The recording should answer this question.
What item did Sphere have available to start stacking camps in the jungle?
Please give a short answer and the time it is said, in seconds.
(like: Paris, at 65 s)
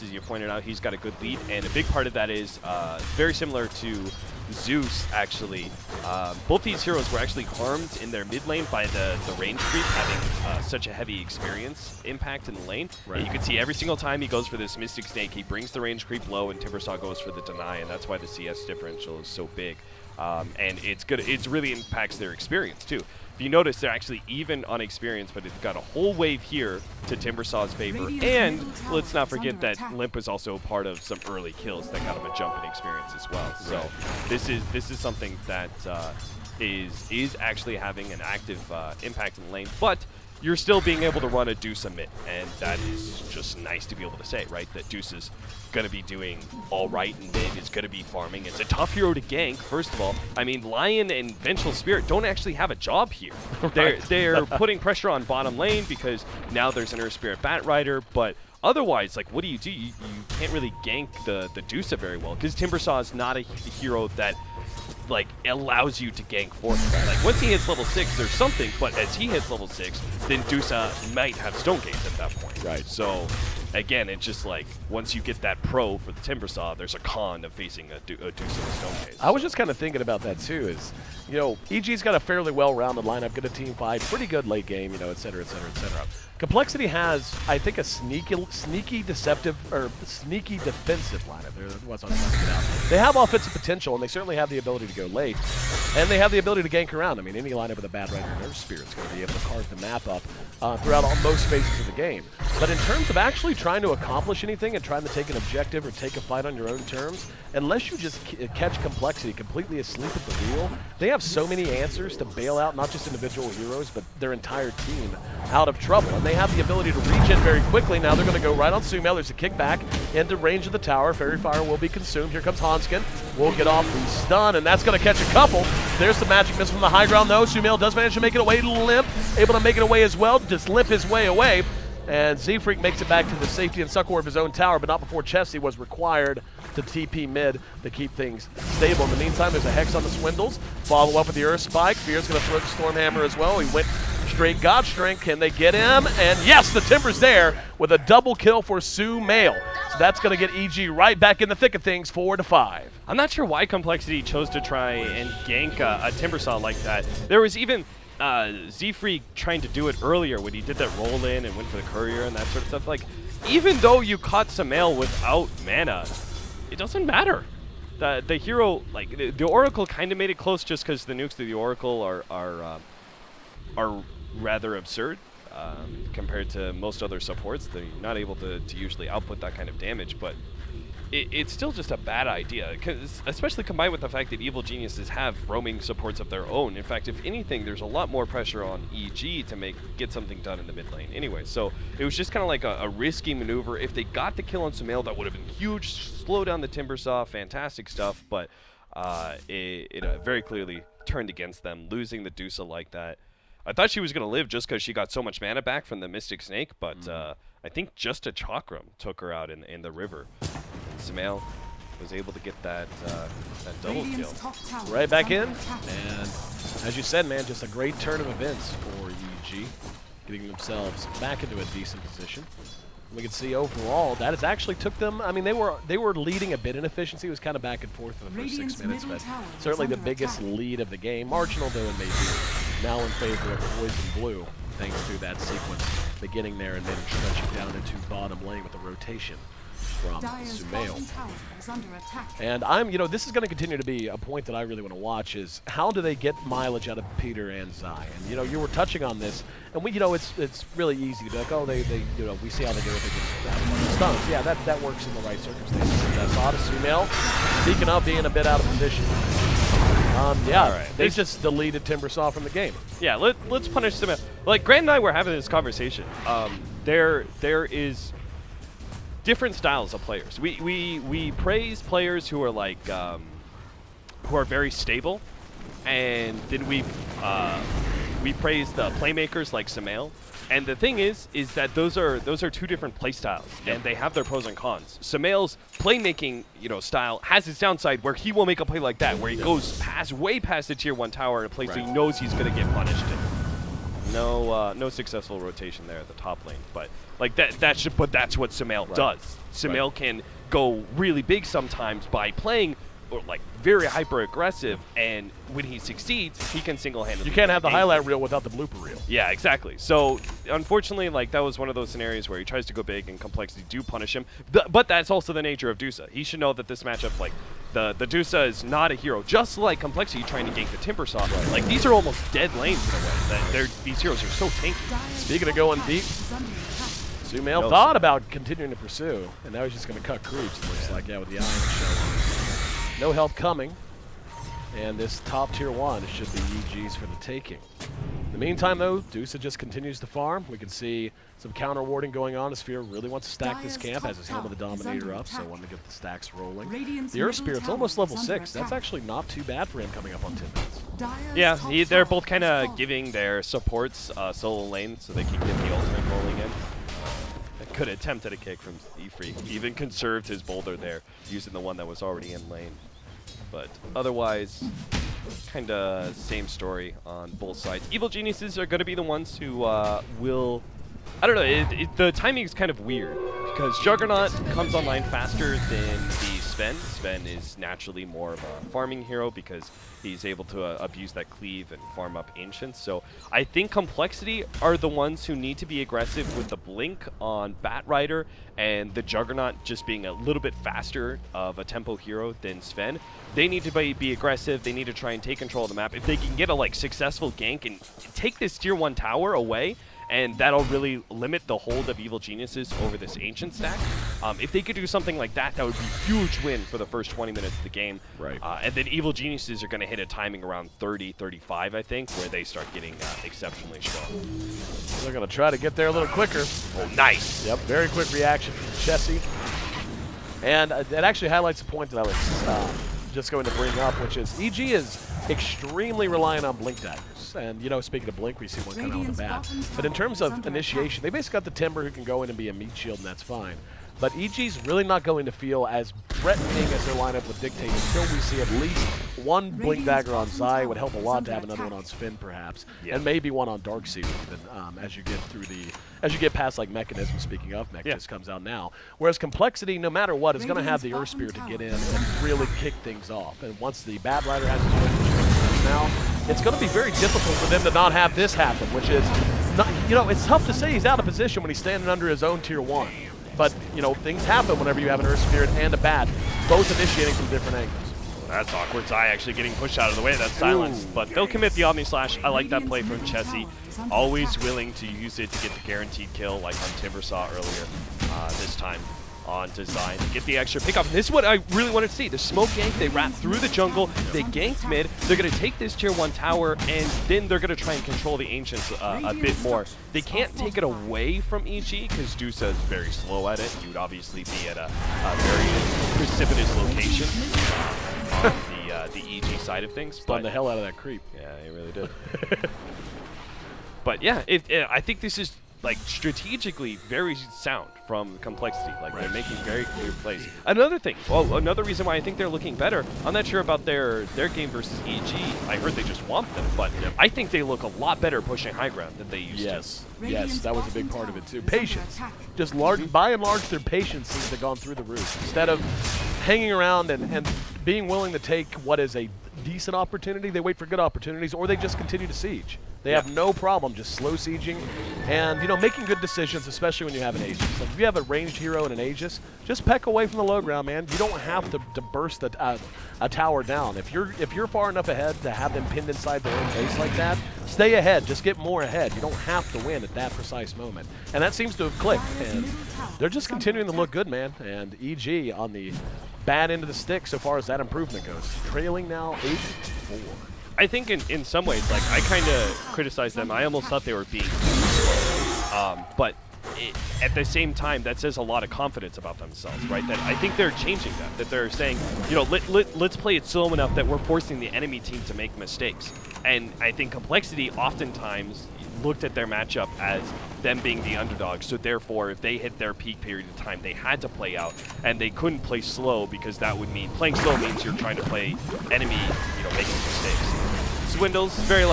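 Helm of the Dominator, at 344 s.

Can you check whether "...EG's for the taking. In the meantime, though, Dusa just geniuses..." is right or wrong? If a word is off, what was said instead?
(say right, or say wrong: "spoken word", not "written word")
wrong: "continues", not "geniuses".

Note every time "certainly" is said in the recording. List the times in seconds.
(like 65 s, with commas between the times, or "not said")
94 s, 229 s.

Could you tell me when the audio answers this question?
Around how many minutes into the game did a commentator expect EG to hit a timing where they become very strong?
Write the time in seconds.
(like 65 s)
410 s.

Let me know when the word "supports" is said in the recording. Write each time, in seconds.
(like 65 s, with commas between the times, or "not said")
177 s, 185 s, 353 s.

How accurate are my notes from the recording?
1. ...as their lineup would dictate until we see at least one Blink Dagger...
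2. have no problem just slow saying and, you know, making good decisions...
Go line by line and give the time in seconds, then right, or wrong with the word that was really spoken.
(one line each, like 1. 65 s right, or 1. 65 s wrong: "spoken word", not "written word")
1. 436 s right
2. 533 s wrong: "sieging", not "saying".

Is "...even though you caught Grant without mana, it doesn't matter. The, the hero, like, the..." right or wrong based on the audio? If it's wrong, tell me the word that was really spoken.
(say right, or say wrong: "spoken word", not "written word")
wrong: "Sumail", not "Grant".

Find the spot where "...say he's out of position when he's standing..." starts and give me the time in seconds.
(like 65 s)
460 s.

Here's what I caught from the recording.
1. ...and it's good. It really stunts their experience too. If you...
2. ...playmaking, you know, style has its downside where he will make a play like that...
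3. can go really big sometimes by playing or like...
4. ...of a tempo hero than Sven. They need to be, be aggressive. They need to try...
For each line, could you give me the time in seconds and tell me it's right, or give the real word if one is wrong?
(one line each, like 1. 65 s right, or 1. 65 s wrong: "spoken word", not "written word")
1. 20 s wrong: "impacts", not "stunts"
2. 285 s right
3. 299 s right
4. 391 s right.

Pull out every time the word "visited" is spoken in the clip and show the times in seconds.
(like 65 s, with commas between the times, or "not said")
not said.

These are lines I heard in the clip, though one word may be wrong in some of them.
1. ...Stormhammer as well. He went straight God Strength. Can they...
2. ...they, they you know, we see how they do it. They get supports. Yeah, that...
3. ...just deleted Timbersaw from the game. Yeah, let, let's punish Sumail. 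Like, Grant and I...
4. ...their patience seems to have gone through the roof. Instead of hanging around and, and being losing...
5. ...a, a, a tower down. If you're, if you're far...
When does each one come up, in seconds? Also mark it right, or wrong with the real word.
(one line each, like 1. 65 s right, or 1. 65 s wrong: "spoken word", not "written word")
1. 142 s right
2. 251 s wrong: "stunts", not "supports"
3. 261 s right
4. 523 s wrong: "willing", not "losing"
5. 542 s right.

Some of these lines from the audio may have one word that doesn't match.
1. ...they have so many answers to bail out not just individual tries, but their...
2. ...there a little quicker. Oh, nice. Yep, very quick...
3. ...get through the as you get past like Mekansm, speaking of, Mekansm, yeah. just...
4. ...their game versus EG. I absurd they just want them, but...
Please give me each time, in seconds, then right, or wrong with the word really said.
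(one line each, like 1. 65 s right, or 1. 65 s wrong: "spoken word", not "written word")
1. 110 s wrong: "heroes", not "tries"
2. 415 s right
3. 445 s right
4. 514 s wrong: "heard", not "absurd".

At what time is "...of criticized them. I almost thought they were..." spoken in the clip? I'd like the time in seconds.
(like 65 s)
562 s.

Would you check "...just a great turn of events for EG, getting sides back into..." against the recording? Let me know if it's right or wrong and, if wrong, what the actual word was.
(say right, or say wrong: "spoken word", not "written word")
wrong: "themselves", not "sides".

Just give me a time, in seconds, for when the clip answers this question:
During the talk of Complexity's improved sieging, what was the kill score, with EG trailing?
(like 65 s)
559 s.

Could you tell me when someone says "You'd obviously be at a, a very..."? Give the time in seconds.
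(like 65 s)
493 s.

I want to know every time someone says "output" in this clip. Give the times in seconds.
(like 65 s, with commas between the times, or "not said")
179 s.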